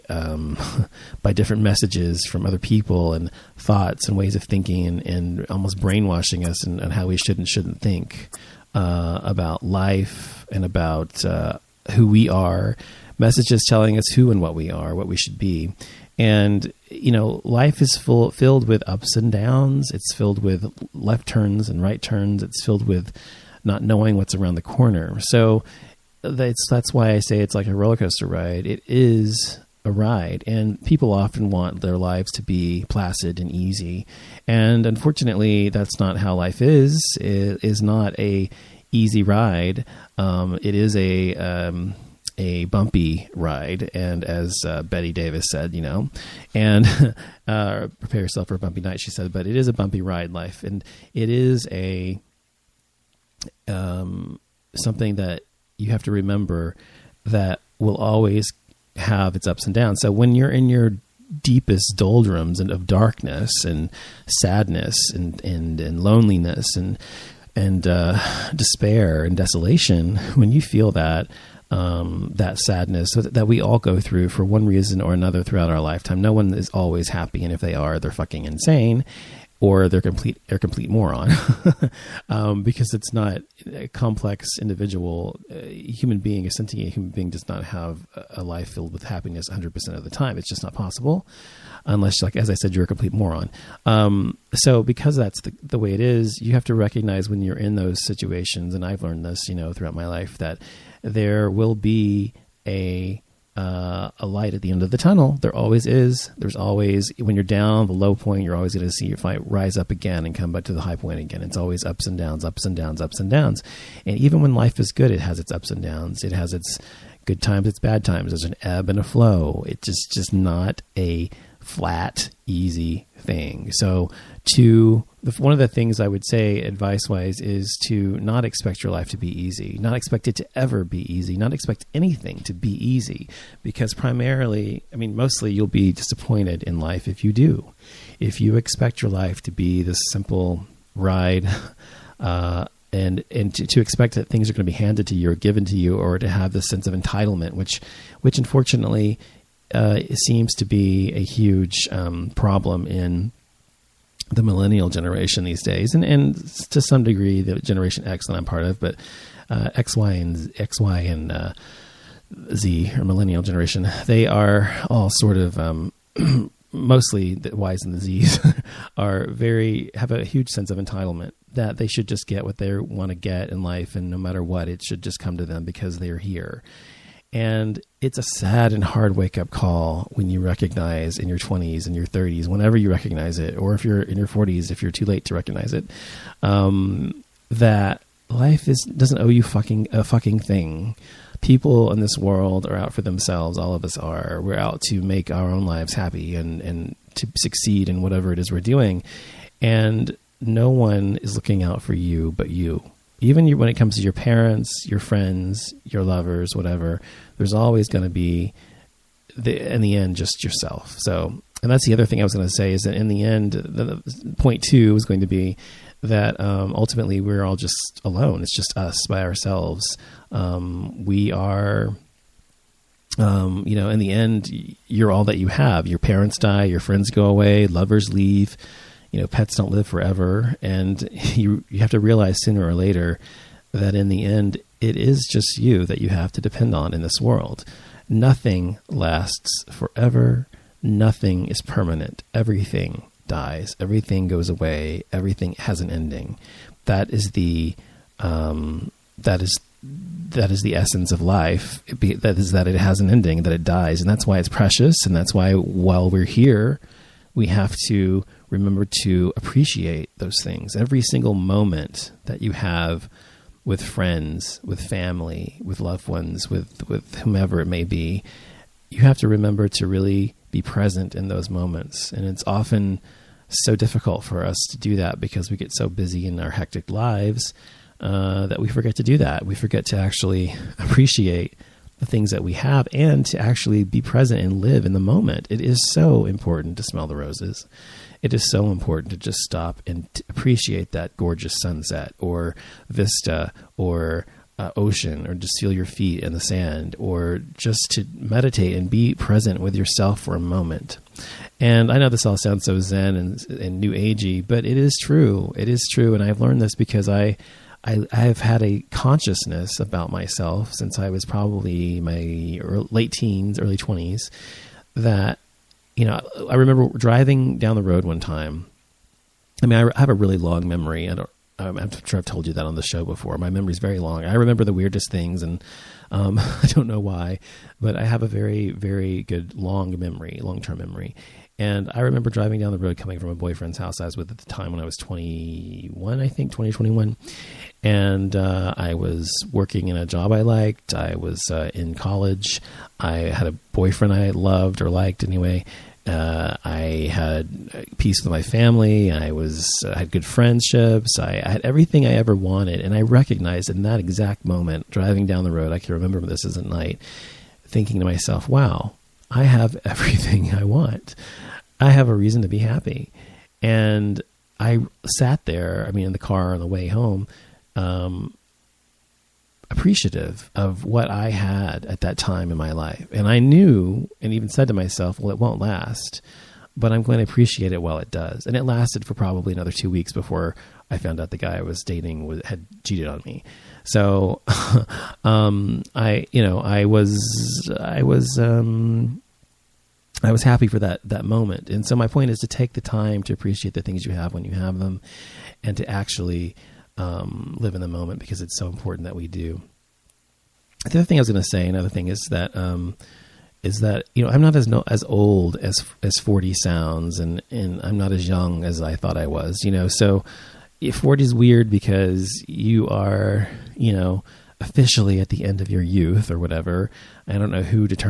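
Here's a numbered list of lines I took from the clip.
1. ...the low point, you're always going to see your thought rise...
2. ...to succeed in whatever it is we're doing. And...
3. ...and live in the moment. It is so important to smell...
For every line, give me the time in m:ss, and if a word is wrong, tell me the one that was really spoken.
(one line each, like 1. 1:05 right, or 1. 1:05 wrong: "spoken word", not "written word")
1. 1:47 wrong: "fight", not "thought"
2. 3:17 right
3. 4:44 right.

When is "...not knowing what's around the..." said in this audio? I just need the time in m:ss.
0:23.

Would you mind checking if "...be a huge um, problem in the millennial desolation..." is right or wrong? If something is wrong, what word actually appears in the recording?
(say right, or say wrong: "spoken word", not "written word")
wrong: "generation", not "desolation".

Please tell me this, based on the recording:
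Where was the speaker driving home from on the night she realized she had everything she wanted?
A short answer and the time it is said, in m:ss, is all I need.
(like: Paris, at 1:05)
a boyfriend's house, at 5:33.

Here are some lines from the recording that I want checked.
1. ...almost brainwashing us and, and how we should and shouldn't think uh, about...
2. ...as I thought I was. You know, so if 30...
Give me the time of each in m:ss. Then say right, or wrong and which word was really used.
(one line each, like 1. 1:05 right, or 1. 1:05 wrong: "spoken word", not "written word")
1. 0:05 right
2. 6:48 wrong: "40", not "30".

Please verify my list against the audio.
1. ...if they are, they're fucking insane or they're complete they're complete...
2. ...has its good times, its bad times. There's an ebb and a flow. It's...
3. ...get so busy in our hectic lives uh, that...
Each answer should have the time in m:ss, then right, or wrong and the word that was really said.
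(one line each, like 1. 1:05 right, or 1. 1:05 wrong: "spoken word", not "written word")
1. 1:17 right
2. 1:56 right
3. 4:35 right.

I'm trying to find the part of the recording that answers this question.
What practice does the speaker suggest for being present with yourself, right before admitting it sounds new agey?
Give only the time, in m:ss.
4:58.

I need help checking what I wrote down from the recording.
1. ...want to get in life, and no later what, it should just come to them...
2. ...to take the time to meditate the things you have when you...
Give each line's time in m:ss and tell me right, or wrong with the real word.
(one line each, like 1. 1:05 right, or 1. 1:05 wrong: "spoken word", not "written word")
1. 2:52 wrong: "matter", not "later"
2. 6:32 wrong: "appreciate", not "meditate".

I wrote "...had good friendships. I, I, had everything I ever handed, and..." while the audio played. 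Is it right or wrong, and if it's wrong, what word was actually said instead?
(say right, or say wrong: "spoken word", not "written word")
wrong: "wanted", not "handed".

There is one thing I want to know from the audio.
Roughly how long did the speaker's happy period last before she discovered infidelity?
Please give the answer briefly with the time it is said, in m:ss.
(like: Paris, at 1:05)
two weeks, at 6:19.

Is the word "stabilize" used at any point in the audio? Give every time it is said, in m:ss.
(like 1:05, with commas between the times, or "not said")
not said.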